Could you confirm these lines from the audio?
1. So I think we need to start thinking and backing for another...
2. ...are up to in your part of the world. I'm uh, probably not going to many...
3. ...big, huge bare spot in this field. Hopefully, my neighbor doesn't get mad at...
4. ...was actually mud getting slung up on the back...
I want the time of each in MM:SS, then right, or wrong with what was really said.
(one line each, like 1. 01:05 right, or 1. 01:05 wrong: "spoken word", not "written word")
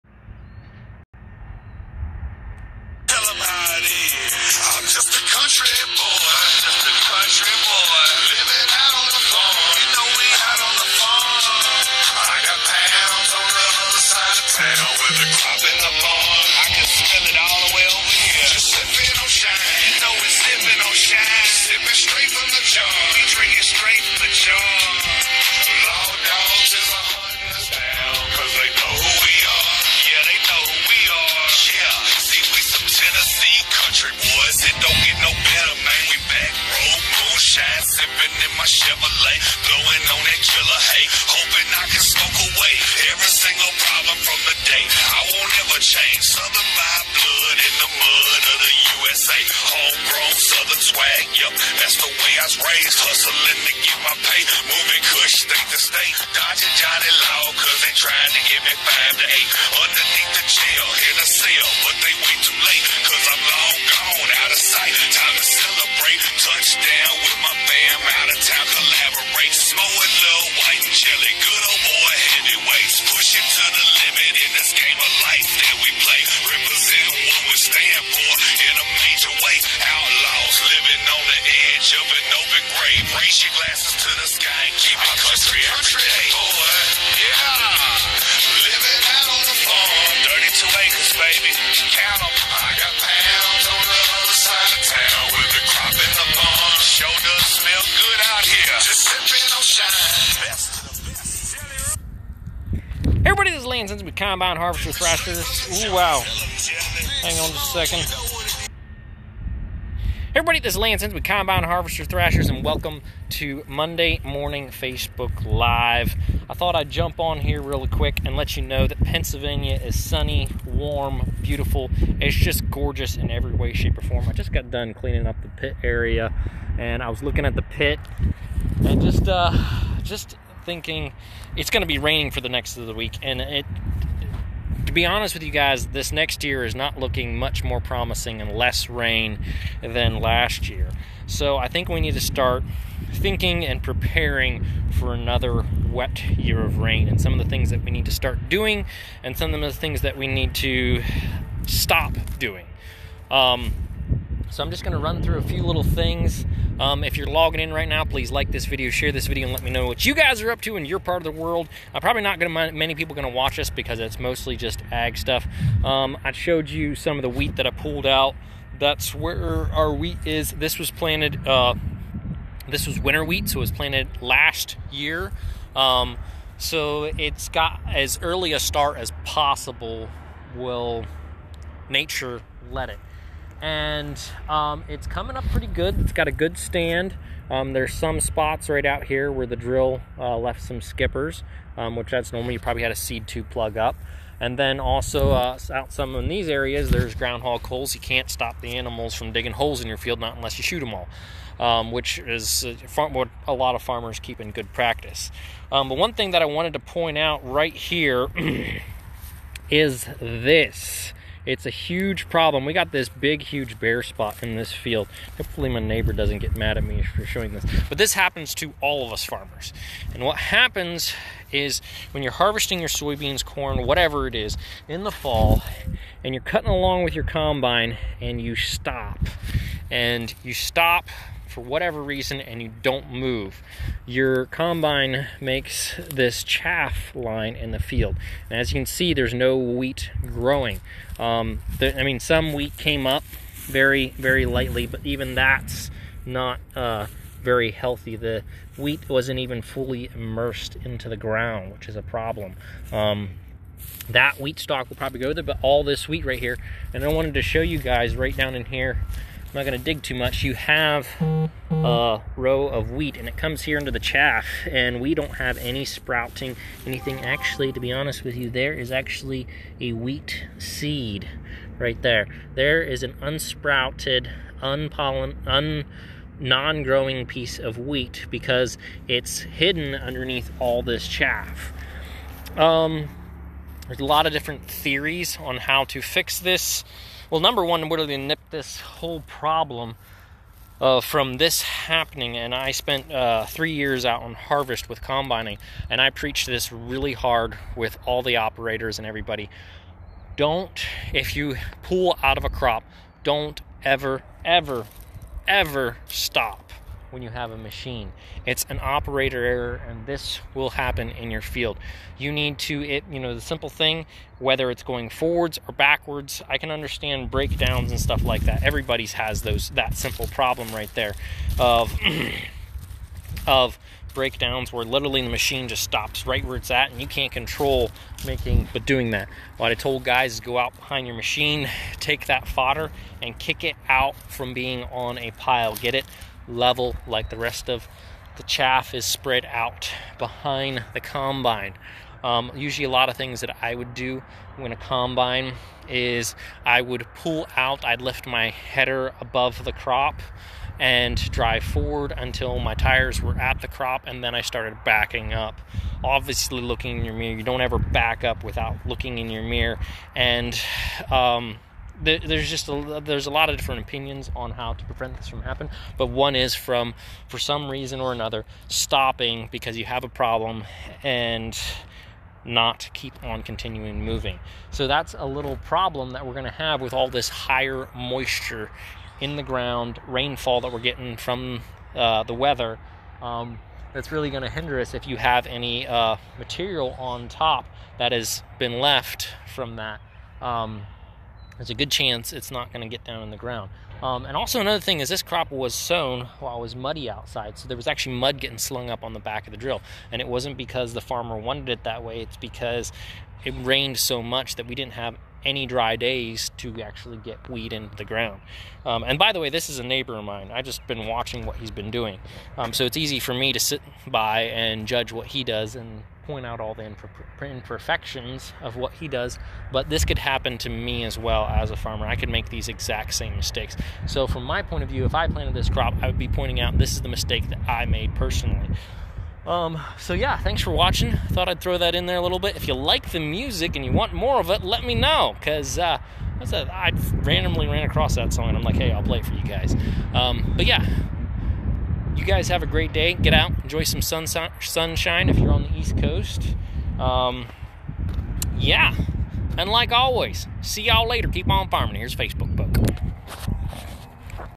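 1. 02:21 wrong: "preparing", not "backing"
2. 02:40 right
3. 03:33 right
4. 06:37 right.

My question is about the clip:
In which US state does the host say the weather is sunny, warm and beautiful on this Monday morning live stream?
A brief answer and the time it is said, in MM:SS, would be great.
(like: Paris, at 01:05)
Pennsylvania, at 01:59.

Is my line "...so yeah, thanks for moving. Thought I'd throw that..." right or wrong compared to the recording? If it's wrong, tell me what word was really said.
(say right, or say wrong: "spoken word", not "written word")
wrong: "watching", not "moving".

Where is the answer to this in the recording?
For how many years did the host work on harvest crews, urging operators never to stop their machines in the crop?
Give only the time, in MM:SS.
04:53.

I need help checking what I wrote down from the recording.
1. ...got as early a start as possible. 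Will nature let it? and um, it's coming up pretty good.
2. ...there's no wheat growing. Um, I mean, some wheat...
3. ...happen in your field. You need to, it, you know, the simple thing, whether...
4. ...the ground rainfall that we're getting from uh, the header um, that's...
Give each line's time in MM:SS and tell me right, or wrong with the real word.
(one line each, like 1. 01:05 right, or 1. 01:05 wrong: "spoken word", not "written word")
1. 02:57 right
2. 03:59 right
3. 05:10 right
4. 06:19 wrong: "weather", not "header".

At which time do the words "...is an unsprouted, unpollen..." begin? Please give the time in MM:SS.
04:32.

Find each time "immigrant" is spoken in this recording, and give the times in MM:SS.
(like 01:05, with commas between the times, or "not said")
not said.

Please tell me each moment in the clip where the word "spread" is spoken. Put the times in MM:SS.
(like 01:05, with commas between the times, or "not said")
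05:39.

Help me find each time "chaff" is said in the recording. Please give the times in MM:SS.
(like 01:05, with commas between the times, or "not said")
03:56, 04:23, 04:41, 05:38.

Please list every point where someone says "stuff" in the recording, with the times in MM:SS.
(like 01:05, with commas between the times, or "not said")
02:45, 05:17.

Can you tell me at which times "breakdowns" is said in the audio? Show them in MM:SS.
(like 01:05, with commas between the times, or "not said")
05:17, 05:24.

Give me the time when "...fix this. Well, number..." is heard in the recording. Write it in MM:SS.
04:46.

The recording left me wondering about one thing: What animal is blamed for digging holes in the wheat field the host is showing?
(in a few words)
groundhog.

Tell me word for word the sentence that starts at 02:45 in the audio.
Um, I showed you some of the wheat that I pulled out.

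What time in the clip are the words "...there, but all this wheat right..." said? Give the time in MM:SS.
04:15.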